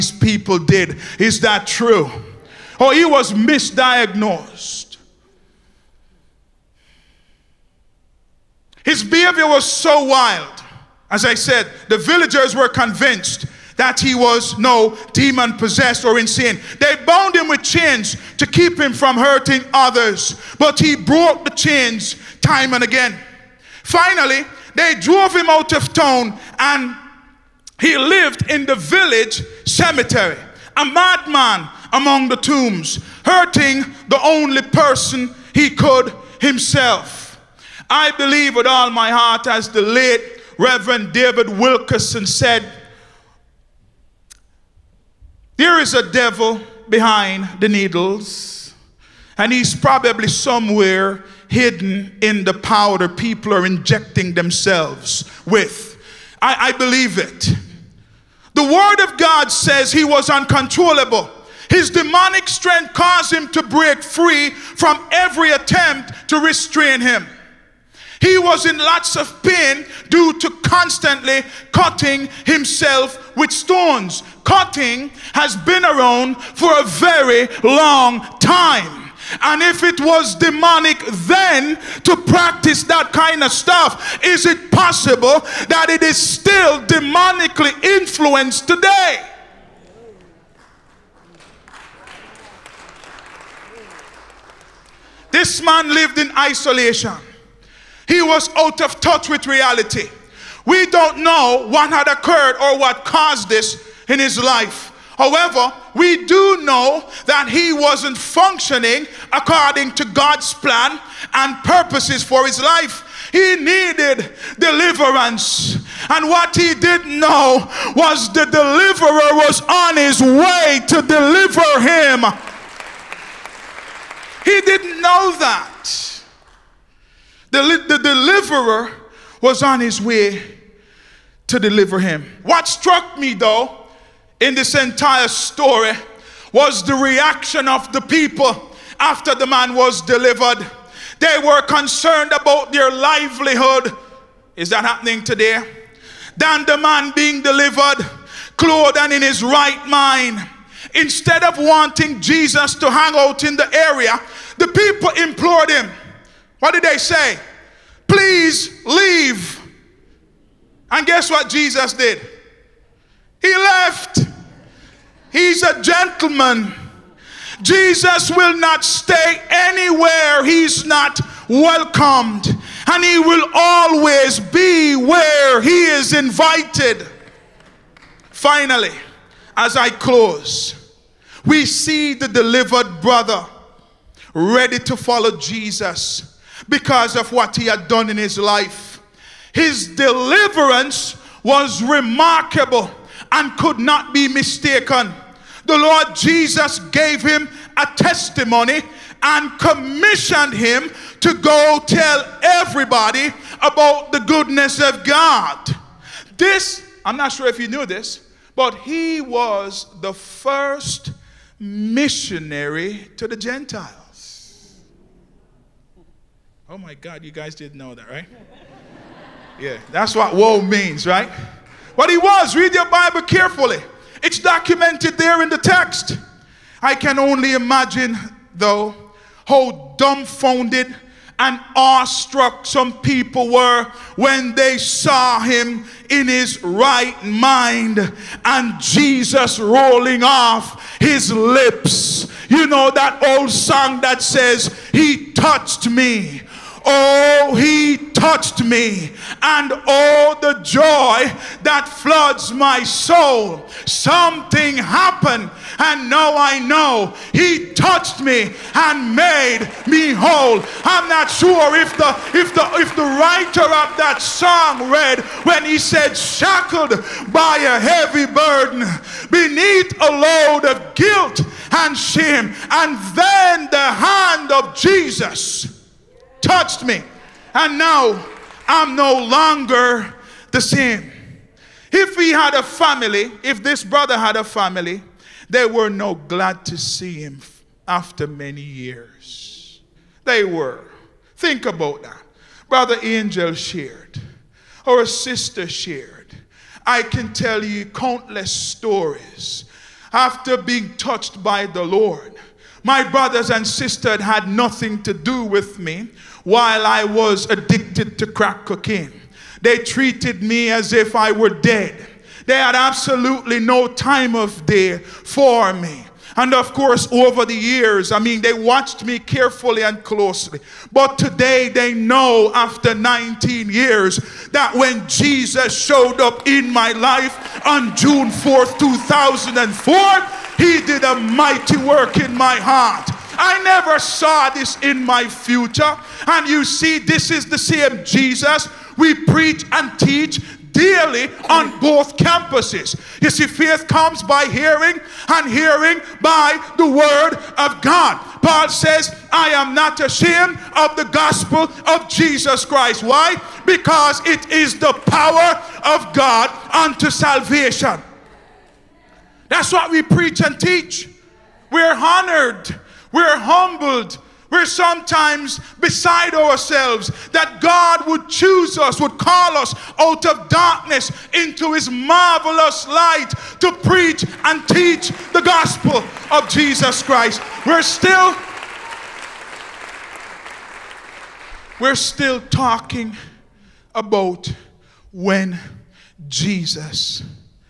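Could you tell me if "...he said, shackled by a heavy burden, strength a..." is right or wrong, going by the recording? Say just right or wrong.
wrong.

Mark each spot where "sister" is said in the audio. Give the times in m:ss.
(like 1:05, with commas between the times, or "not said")
4:55, 5:03.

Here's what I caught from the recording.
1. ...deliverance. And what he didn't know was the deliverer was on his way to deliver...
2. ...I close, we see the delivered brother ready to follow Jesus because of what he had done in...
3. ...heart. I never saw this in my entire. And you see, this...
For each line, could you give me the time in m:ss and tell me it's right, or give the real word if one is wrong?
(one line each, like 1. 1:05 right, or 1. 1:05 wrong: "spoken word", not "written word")
1. 1:54 right
2. 2:59 right
3. 5:32 wrong: "future", not "entire".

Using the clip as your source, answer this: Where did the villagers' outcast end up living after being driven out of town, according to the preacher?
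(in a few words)
The village cemetery.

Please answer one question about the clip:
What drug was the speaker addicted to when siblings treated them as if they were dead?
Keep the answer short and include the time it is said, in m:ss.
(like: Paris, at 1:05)
Crack cocaine, at 5:08.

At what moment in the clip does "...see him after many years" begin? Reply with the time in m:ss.
4:46.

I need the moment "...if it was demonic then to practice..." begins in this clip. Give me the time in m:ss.
1:19.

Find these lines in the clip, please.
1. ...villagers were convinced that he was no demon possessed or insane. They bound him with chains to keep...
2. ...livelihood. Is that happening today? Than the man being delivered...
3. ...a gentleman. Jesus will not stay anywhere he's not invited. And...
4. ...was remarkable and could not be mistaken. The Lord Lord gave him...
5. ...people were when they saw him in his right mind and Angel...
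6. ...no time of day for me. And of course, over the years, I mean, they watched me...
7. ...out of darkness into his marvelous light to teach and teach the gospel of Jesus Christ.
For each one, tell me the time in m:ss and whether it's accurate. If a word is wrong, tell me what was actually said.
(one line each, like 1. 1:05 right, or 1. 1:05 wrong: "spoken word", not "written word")
1. 0:11 right
2. 2:22 right
3. 2:45 wrong: "welcomed", not "invited"
4. 3:11 wrong: "Jesus", not "Lord"
5. 3:53 wrong: "Jesus", not "Angel"
6. 5:13 right
7. 6:09 wrong: "preach", not "teach".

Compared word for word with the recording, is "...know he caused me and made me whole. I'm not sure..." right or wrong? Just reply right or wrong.
wrong.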